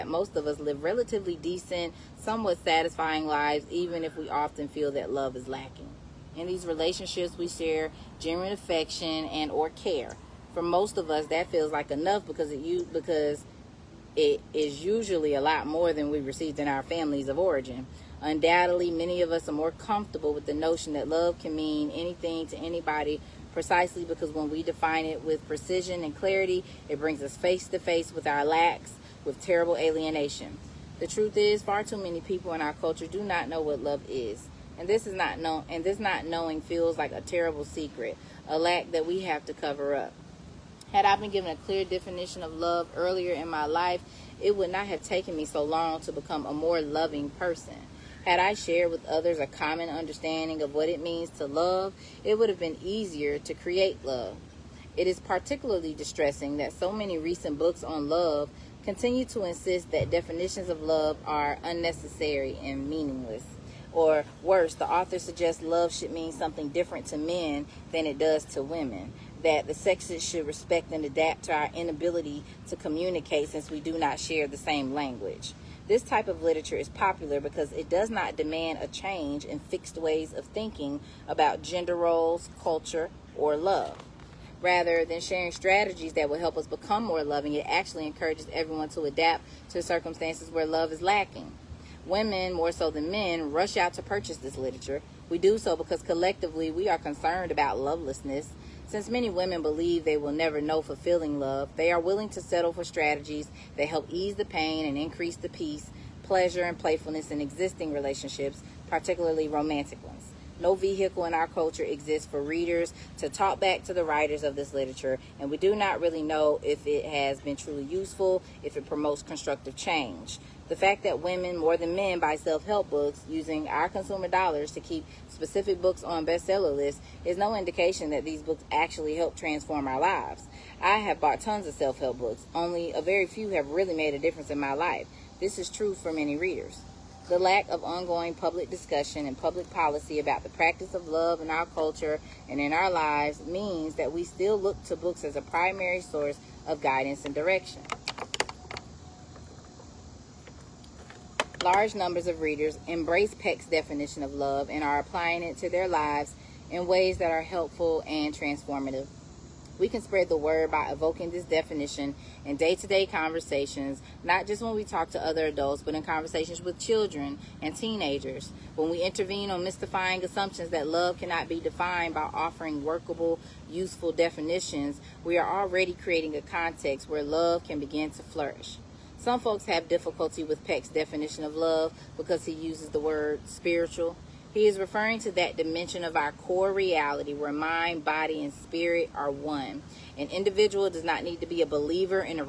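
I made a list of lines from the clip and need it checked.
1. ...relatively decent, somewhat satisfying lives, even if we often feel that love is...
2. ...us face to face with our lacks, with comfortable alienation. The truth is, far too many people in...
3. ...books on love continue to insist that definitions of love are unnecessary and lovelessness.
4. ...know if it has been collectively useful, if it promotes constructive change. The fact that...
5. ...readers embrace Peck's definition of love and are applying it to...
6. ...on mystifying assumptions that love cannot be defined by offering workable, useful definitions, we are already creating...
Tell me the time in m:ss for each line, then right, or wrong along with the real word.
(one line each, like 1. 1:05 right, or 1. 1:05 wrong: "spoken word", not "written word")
1. 0:00 right
2. 0:27 wrong: "terrible", not "comfortable"
3. 0:57 wrong: "meaningless", not "lovelessness"
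4. 1:56 wrong: "truly", not "collectively"
5. 2:32 right
6. 2:49 right.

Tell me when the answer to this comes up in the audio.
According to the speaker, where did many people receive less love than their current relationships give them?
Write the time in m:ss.
0:16.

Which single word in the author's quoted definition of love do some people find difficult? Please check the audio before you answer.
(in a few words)
spiritual.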